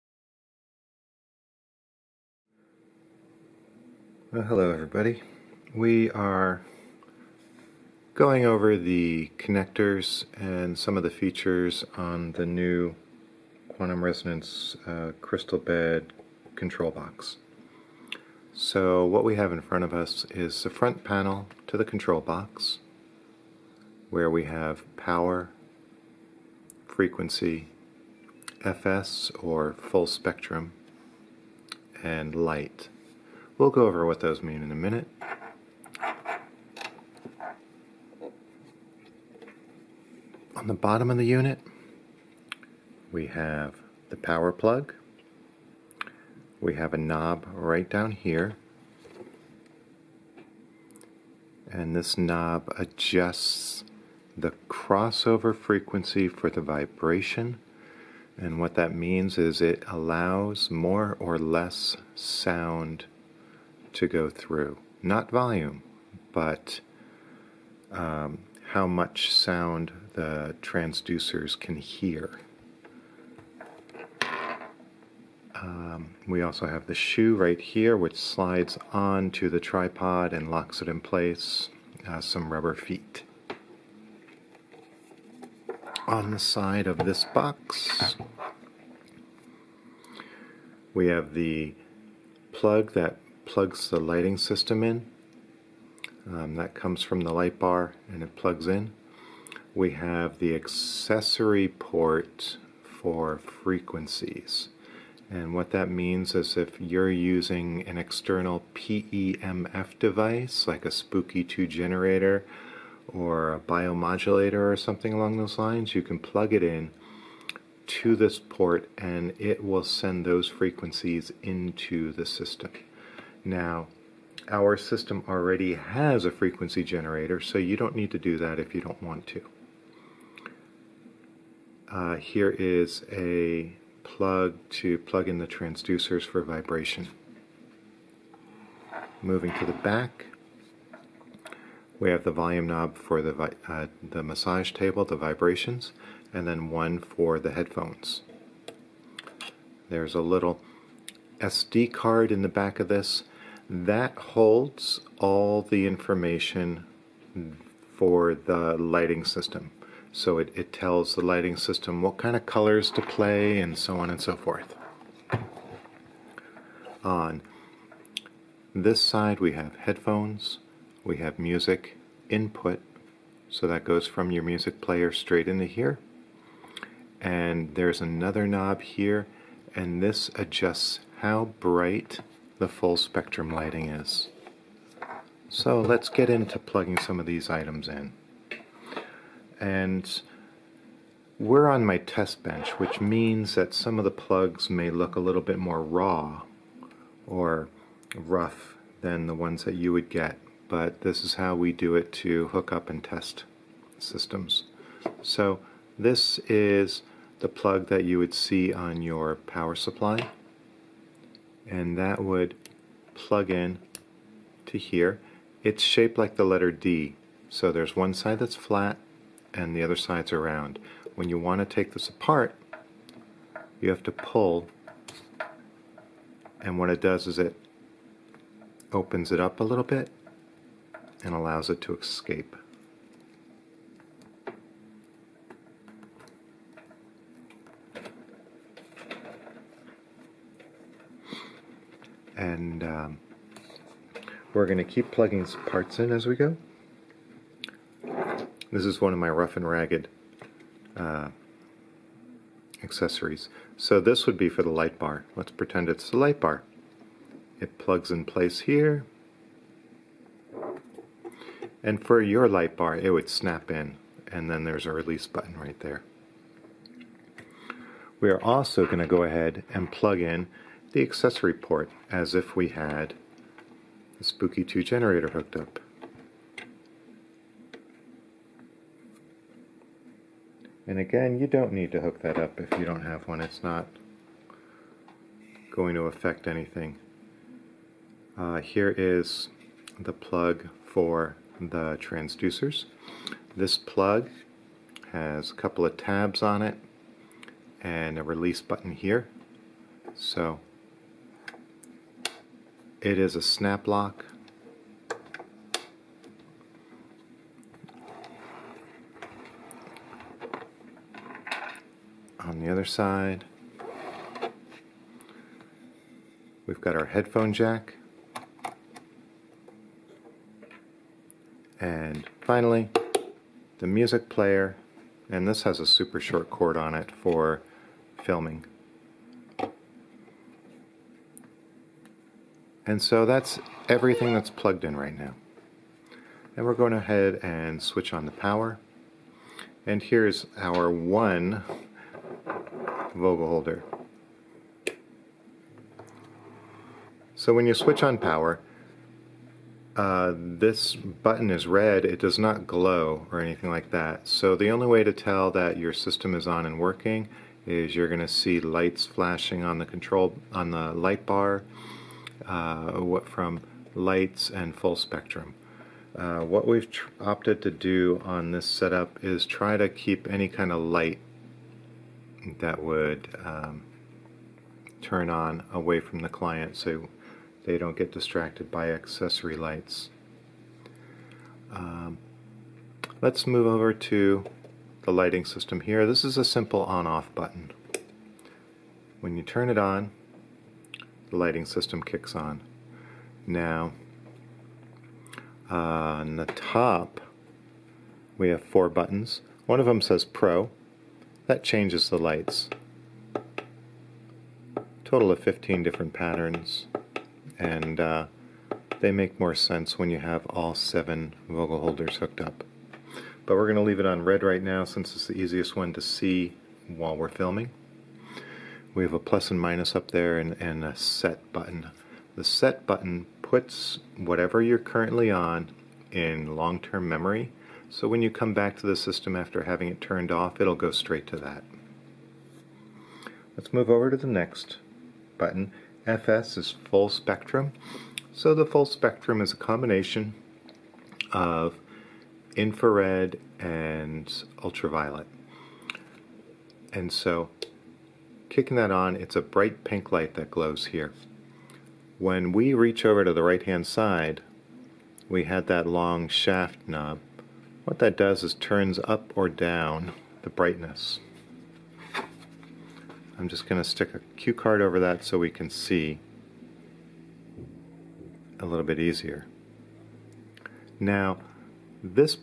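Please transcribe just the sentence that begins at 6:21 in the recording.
Um, let's move over to the lighting system here.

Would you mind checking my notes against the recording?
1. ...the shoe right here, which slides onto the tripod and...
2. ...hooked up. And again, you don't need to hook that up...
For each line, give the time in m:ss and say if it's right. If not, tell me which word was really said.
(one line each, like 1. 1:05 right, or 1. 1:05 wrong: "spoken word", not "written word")
1. 1:16 right
2. 4:35 right.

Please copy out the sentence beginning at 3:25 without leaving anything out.
So this is the plug that you would see on your power supply and that would plug in to here.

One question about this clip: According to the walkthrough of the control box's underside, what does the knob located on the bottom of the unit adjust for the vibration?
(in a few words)
Crossover frequency.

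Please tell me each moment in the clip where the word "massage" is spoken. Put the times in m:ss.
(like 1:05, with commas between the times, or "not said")
2:24.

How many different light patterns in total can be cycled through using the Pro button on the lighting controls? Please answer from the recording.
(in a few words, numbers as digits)
15.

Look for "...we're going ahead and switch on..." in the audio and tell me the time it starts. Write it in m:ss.
5:36.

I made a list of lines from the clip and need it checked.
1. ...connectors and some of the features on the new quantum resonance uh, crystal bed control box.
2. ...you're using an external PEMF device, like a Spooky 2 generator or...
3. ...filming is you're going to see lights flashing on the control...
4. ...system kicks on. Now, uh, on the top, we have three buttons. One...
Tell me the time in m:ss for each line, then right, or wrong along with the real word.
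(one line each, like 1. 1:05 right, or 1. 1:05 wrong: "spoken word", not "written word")
1. 0:09 right
2. 1:46 right
3. 5:56 wrong: "working", not "filming"
4. 6:31 wrong: "four", not "three".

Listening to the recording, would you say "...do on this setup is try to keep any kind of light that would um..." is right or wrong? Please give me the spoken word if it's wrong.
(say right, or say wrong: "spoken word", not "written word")
right.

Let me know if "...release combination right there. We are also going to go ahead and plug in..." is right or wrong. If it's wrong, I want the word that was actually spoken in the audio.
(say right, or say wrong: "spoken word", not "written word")
wrong: "button", not "combination".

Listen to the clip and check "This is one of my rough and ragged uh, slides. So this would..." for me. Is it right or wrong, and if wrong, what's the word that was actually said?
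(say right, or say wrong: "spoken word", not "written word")
wrong: "accessories", not "slides".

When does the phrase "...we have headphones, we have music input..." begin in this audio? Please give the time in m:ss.
2:49.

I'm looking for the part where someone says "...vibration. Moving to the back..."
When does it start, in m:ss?
2:16.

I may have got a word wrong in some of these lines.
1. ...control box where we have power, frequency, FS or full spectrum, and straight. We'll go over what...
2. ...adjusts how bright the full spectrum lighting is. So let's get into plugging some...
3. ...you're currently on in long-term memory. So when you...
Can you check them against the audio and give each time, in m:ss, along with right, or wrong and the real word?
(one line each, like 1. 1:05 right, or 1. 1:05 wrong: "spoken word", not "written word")
1. 0:21 wrong: "light", not "straight"
2. 3:00 right
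3. 7:04 right.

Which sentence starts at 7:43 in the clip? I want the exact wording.
I'm just going to stick a cue card over that so we can see a little bit easier.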